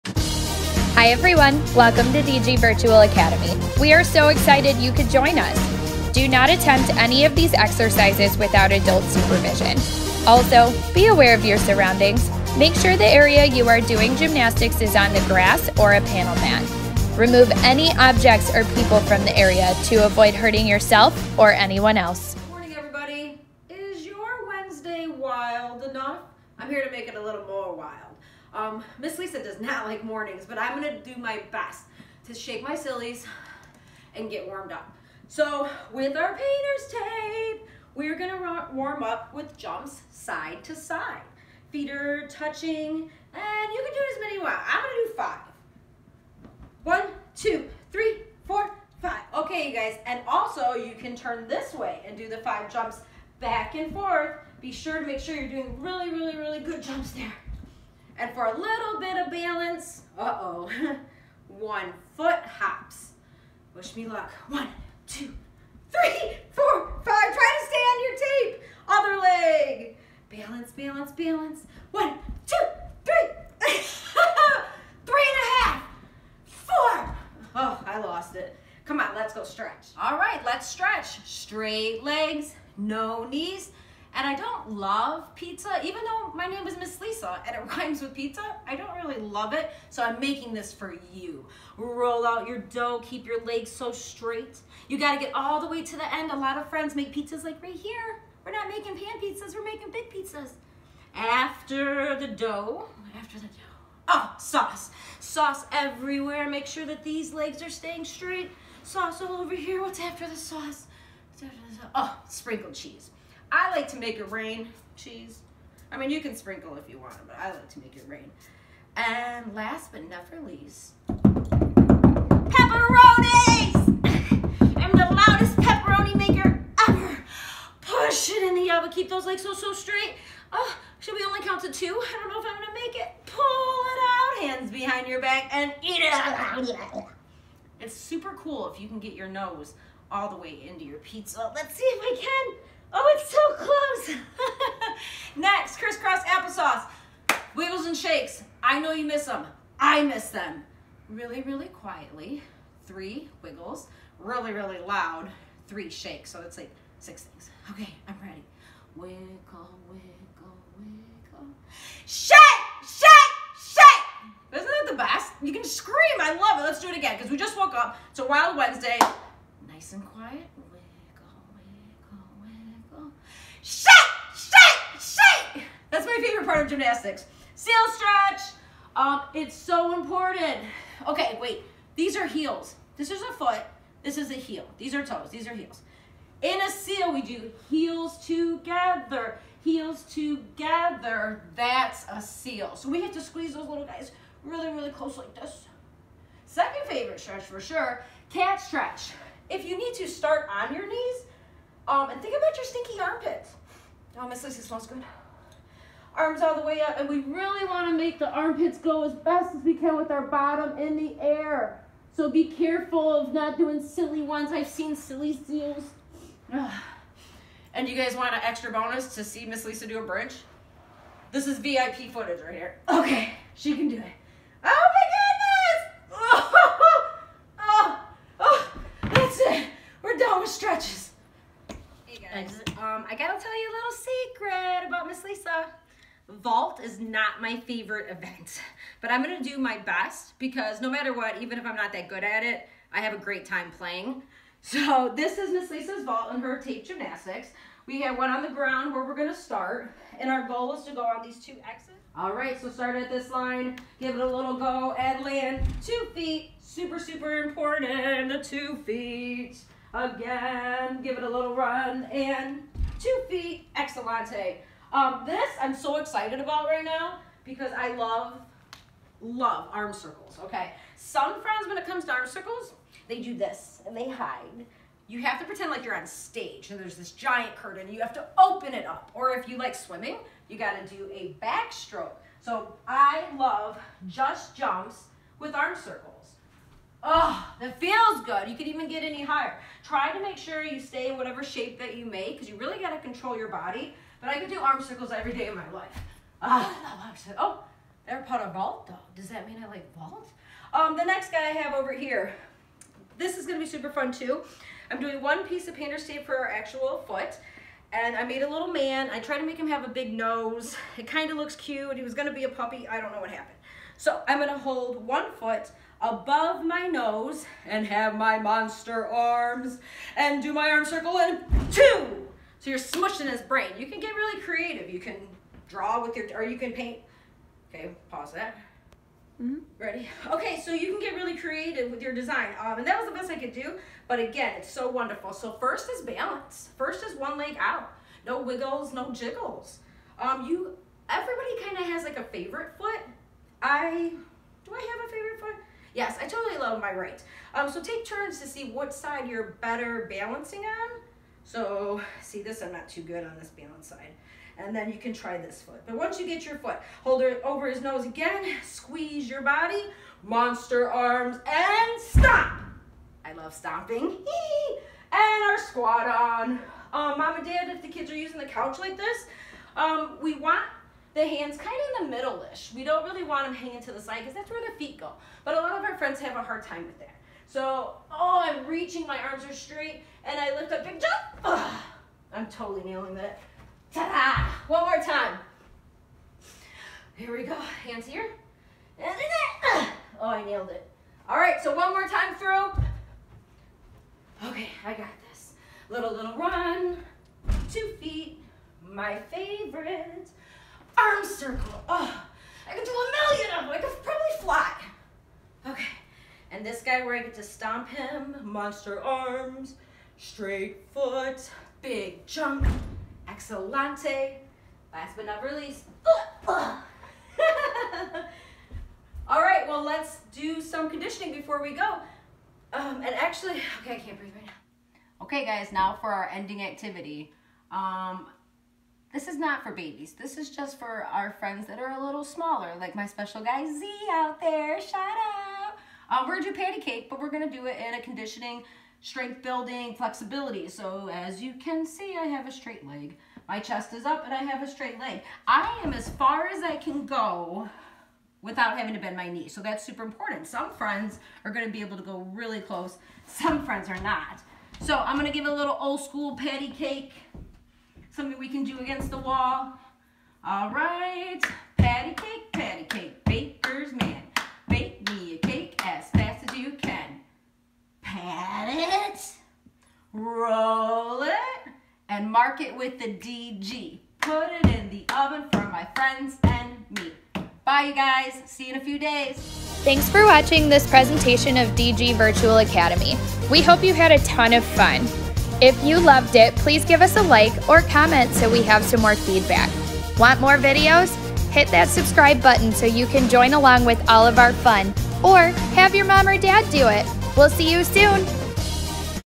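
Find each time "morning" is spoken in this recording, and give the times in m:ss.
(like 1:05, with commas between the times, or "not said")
0:22, 0:30.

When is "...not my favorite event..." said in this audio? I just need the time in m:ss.
3:56.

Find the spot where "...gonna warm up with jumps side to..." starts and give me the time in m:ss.
0:38.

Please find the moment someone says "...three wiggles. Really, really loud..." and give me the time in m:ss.
2:32.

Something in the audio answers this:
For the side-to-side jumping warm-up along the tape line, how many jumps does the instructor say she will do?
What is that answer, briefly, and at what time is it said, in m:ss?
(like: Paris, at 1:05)
5, at 0:44.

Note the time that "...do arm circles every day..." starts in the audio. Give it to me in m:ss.
4:54.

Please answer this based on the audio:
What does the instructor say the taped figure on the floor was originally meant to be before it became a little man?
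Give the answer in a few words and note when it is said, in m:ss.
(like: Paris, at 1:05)
A puppy, at 5:12.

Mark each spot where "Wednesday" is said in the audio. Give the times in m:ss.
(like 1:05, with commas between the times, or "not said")
0:24, 2:48.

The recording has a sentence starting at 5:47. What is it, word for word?
Um, so take turns to see what side you're better balancing on.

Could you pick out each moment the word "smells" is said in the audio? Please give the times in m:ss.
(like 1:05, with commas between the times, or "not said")
3:24.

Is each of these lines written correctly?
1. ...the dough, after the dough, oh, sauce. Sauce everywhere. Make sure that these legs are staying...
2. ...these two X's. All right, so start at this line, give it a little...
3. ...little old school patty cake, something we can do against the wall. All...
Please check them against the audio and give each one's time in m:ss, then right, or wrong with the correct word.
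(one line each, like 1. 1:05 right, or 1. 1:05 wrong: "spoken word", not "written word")
1. 1:42 right
2. 4:11 right
3. 7:35 right.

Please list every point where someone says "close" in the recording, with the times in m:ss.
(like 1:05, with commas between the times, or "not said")
2:24, 3:14, 7:32.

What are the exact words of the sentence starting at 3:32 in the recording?
So be careful of not doing silly ones.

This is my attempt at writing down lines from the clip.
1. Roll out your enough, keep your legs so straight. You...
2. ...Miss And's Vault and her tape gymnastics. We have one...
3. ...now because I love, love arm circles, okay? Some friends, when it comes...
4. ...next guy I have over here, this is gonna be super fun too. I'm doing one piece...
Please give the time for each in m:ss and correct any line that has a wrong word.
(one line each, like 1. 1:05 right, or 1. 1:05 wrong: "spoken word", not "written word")
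1. 1:31 wrong: "dough", not "enough"
2. 4:05 wrong: "Lisa", not "And"
3. 4:26 right
4. 5:01 right.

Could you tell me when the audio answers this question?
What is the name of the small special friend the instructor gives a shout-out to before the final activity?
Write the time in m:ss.
7:13.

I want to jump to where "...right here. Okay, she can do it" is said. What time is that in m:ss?
3:42.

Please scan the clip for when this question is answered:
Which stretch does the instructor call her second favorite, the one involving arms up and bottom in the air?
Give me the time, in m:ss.
3:18.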